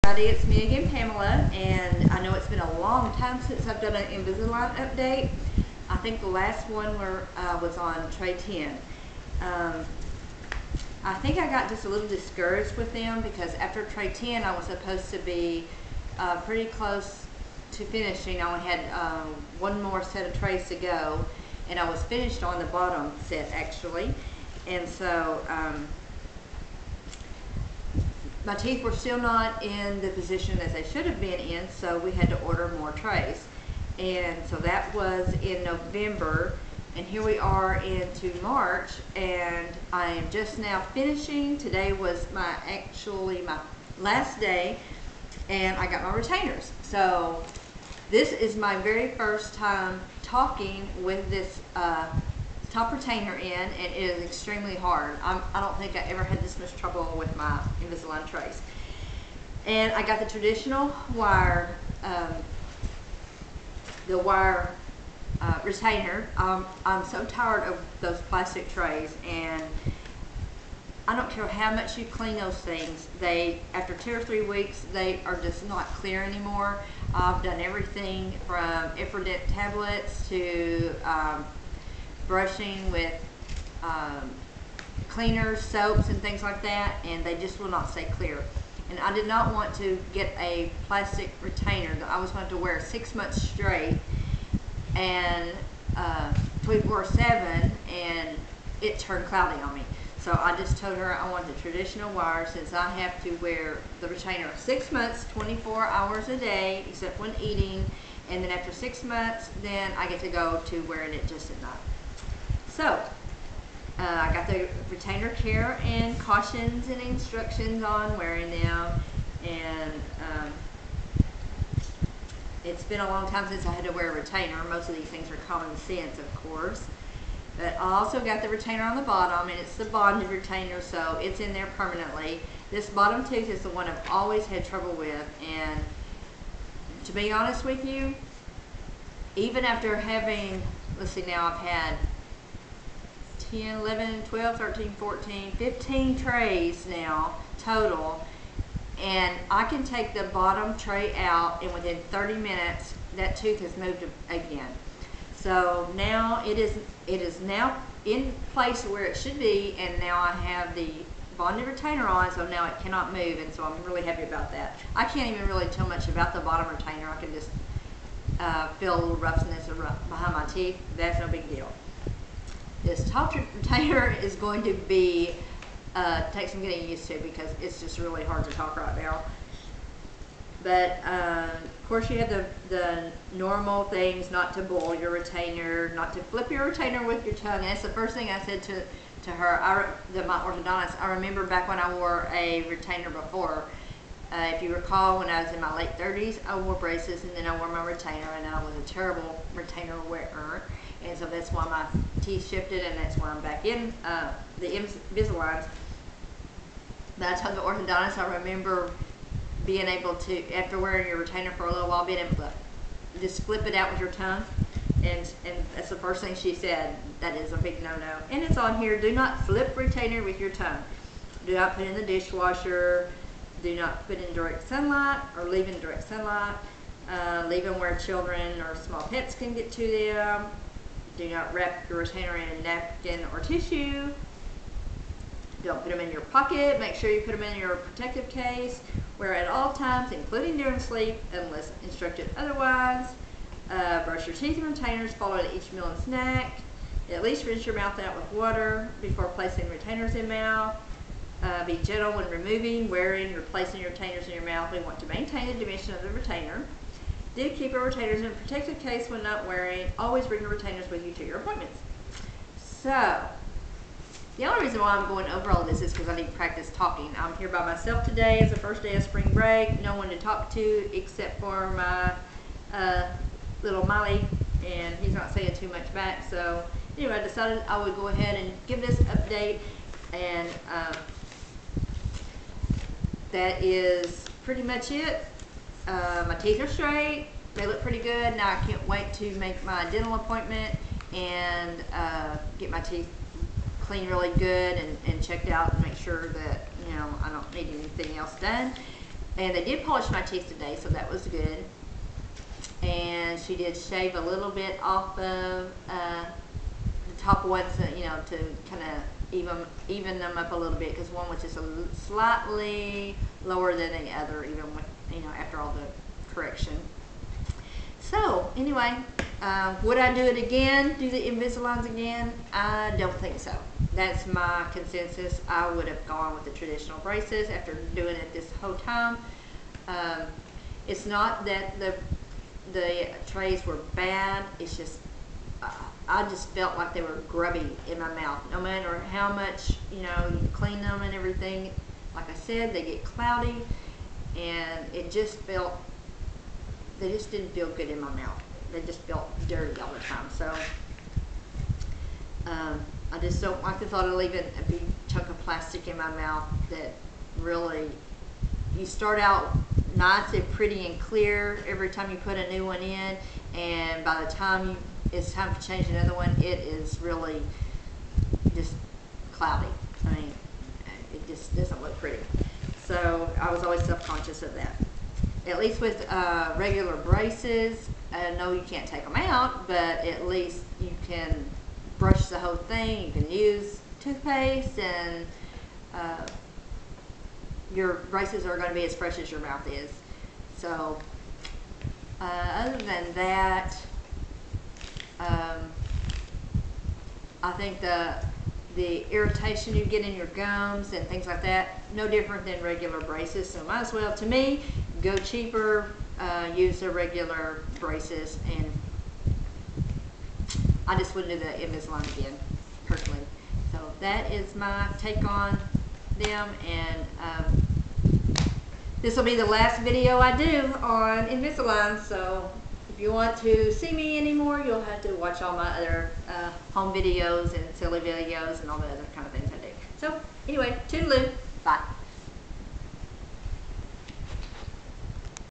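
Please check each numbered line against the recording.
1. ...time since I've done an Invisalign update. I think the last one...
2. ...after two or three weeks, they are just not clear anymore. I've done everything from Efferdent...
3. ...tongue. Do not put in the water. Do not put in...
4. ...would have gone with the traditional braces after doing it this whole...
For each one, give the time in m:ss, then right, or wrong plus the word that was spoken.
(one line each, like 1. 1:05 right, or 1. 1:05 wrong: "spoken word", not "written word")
1. 0:03 right
2. 1:13 right
3. 3:40 wrong: "dishwasher", not "water"
4. 5:25 right.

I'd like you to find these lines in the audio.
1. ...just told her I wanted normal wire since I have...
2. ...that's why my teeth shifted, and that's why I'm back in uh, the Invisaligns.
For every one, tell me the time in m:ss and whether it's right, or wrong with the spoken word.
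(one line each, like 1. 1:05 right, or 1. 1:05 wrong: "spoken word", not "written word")
1. 1:40 wrong: "traditional", not "normal"
2. 3:21 right.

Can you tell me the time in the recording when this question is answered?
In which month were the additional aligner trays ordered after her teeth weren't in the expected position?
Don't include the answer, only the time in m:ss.
0:35.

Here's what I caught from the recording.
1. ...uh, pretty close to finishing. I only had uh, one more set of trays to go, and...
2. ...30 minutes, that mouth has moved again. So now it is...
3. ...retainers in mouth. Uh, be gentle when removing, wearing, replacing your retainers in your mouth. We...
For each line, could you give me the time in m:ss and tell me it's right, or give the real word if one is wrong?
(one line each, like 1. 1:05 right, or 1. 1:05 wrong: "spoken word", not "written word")
1. 0:16 right
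2. 2:32 wrong: "tooth", not "mouth"
3. 4:09 right.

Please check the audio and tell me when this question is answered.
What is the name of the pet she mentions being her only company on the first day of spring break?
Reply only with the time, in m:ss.
4:33.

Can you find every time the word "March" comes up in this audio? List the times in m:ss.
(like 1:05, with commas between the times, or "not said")
0:38.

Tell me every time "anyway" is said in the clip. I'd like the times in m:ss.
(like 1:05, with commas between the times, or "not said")
4:36, 5:18, 7:10.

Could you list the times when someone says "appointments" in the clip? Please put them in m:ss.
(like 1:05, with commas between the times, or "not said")
4:21, 4:50.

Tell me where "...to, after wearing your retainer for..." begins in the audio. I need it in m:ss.
3:30.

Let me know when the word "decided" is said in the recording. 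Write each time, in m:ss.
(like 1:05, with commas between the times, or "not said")
4:37.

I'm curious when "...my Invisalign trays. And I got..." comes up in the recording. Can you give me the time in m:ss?
0:57.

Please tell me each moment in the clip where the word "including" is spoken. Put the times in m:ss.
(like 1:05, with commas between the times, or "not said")
4:00.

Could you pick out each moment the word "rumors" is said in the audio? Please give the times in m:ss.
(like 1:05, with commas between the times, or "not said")
not said.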